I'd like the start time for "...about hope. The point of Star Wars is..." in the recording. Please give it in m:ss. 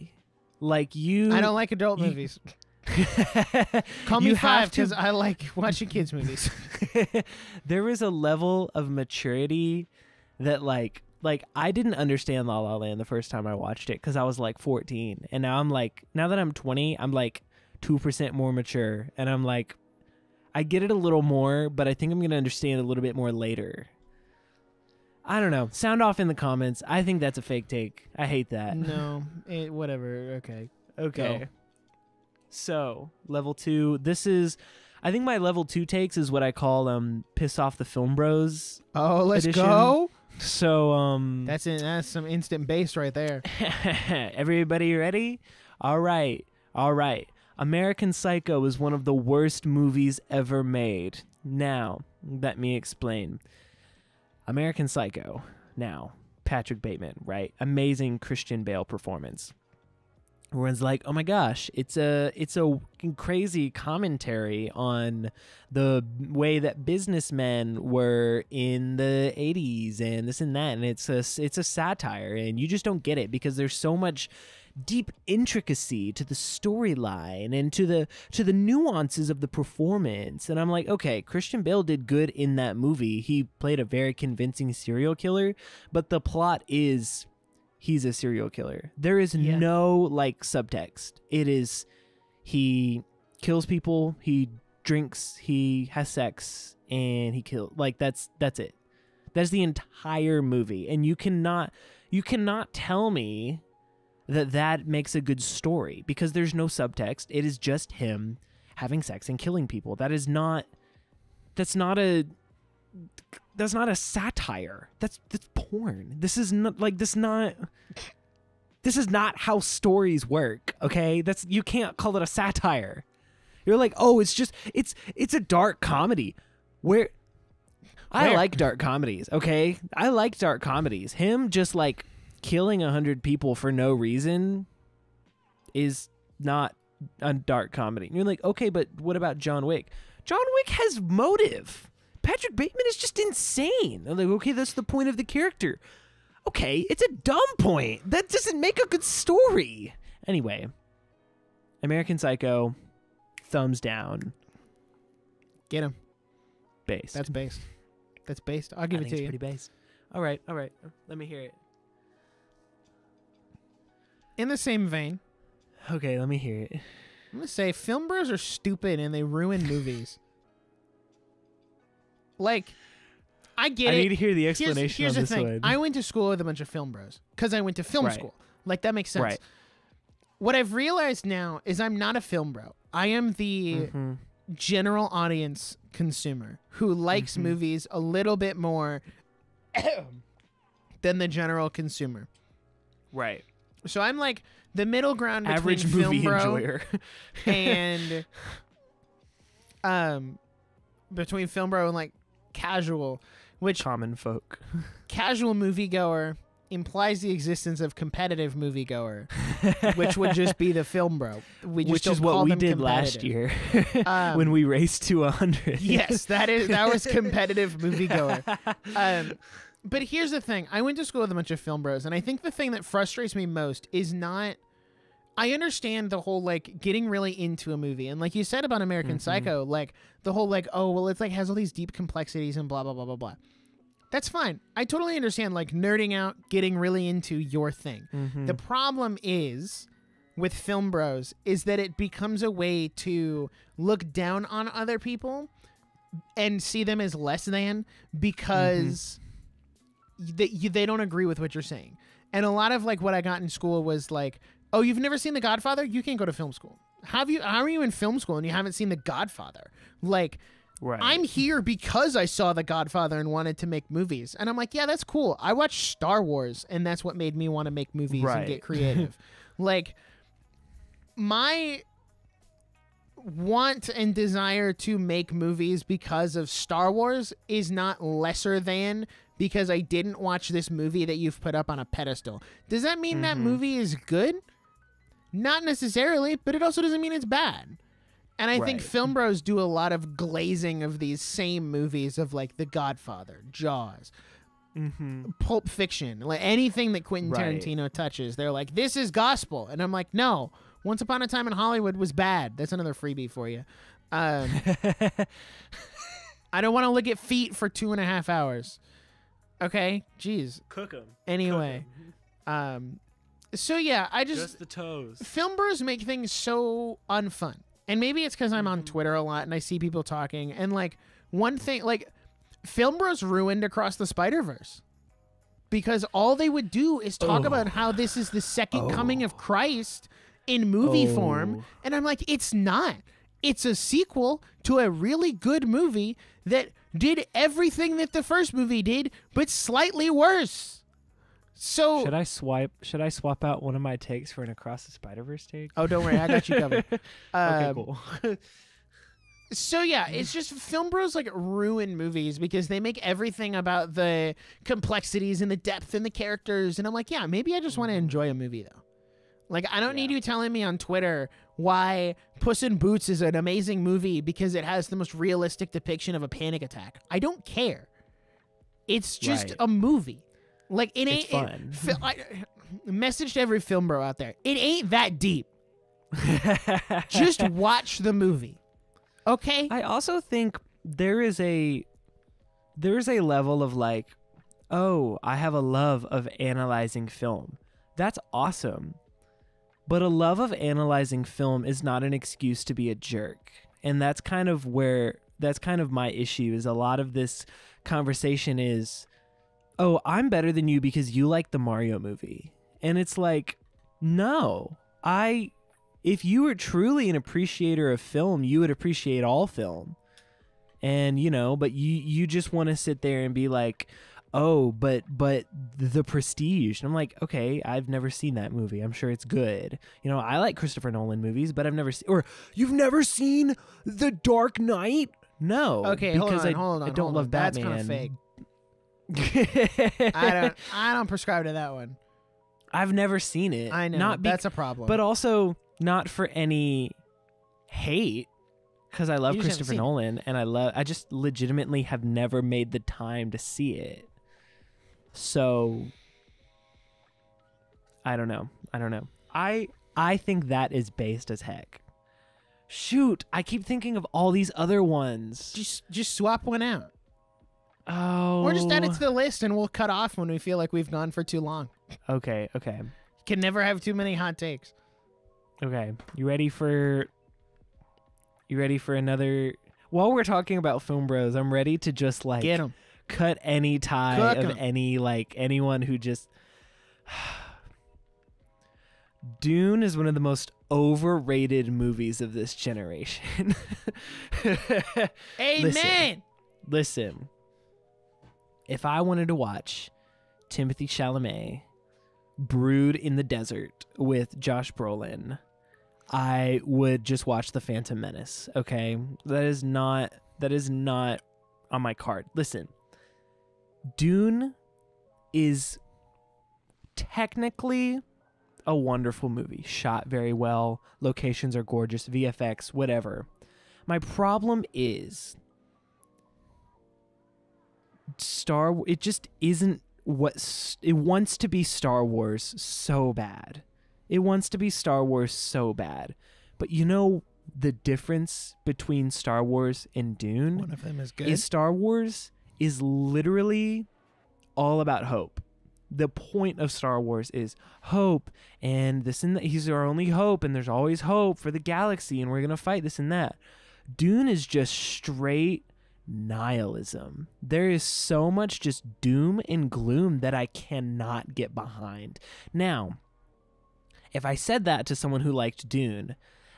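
8:54.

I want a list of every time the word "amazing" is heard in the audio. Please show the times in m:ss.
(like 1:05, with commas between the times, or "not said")
0:57, 6:03.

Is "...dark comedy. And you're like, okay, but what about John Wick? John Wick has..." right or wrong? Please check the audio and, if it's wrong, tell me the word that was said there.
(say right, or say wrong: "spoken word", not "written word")
right.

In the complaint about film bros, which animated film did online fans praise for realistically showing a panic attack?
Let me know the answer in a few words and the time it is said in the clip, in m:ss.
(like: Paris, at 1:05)
Puss in Boots, at 6:02.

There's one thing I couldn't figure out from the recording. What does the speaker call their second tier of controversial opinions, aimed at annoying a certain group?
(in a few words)
piss off the film bros.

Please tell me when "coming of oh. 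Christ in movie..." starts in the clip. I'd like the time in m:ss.
5:28.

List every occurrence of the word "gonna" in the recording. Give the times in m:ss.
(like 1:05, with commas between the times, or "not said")
0:22, 2:47, 9:02.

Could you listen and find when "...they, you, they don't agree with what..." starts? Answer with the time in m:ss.
4:10.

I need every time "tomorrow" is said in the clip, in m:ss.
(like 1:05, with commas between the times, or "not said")
not said.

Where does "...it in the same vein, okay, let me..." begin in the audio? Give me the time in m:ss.
2:41.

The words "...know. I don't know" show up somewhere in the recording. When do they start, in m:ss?
7:28.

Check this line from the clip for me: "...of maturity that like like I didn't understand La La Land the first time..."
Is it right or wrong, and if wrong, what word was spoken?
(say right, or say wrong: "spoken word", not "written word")
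right.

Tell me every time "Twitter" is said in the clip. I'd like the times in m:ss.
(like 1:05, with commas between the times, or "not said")
5:18, 6:00.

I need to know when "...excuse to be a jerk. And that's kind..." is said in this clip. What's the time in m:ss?
6:32.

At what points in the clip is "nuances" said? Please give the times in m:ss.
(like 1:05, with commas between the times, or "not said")
1:18.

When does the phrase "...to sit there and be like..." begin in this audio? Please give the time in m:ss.
6:52.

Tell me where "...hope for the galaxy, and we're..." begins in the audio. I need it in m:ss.
9:01.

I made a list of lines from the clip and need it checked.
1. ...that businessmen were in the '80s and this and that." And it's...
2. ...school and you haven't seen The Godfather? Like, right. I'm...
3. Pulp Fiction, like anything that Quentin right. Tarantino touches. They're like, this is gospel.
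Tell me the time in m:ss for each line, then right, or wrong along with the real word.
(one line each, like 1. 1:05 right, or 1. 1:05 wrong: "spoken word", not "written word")
1. 1:06 right
2. 4:18 right
3. 4:55 right.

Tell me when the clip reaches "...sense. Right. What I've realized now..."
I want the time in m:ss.
2:59.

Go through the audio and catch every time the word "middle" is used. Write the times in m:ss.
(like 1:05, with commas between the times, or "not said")
3:14.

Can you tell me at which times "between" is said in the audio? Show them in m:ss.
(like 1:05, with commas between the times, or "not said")
3:15, 3:21, 8:48.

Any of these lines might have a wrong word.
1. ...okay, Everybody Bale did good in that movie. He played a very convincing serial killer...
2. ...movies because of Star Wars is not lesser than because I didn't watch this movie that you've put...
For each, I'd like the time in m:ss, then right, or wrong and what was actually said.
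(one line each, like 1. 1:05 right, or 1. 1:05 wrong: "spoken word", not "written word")
1. 1:20 wrong: "Christian", not "Everybody"
2. 4:35 right.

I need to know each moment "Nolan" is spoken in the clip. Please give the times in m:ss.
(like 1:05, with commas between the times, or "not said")
7:00, 7:19.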